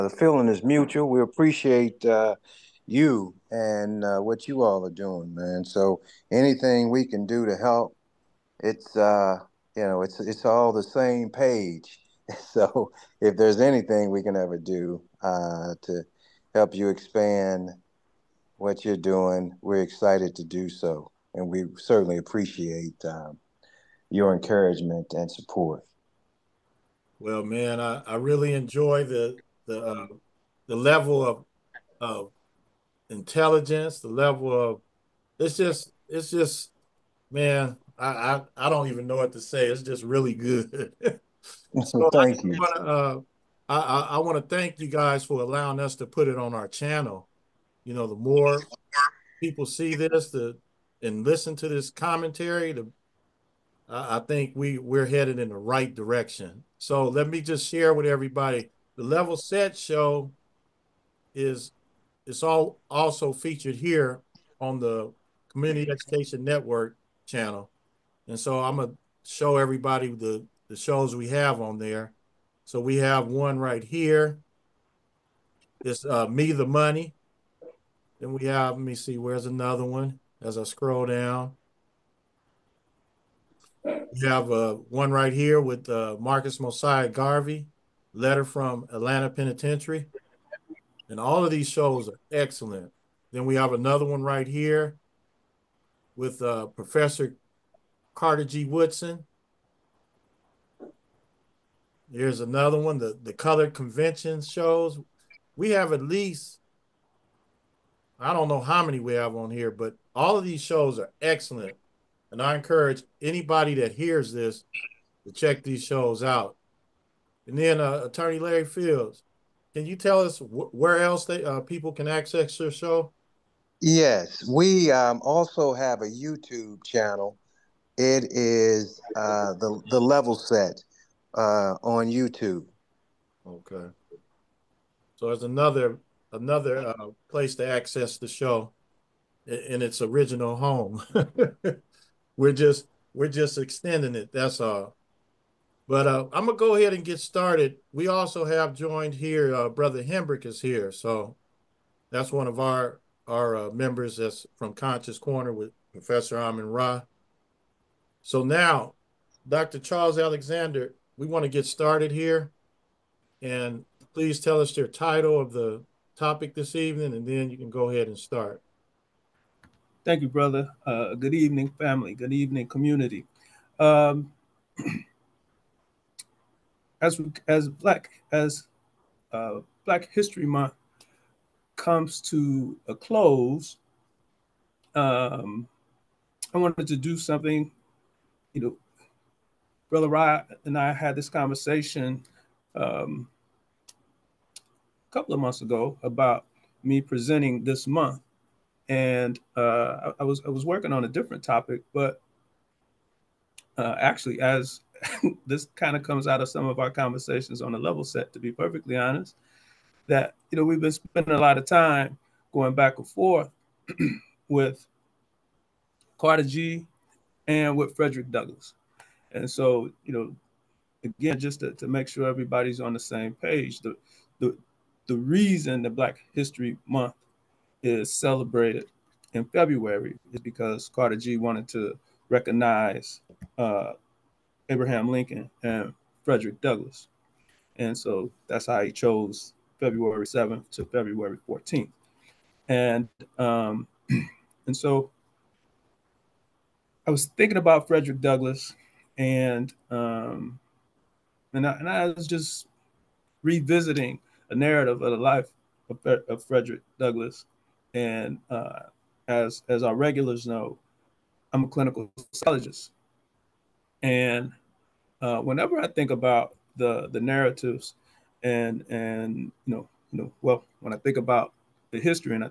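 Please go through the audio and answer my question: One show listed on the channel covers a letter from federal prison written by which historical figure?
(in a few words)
Marcus Mosiah Garvey.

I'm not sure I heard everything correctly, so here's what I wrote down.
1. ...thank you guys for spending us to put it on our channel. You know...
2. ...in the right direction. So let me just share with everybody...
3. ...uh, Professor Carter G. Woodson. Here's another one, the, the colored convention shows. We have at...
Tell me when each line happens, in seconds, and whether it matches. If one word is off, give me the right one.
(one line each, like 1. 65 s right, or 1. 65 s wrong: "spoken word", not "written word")
1. 44 s wrong: "allowing", not "spending"
2. 55 s right
3. 96 s right.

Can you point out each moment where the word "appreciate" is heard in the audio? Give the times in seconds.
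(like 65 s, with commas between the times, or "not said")
1 s, 22 s.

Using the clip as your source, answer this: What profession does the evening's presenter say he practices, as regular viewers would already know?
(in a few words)
Clinical psychologist.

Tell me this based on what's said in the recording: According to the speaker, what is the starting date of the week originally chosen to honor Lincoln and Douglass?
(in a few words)
February 7th.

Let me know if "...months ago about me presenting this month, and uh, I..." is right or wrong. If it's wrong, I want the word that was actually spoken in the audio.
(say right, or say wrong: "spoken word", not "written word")
right.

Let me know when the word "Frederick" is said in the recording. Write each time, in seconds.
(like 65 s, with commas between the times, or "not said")
217 s, 236 s, 247 s, 256 s.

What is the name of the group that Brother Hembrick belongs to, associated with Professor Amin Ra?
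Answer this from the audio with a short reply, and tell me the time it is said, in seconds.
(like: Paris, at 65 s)
Conscious Corner, at 154 s.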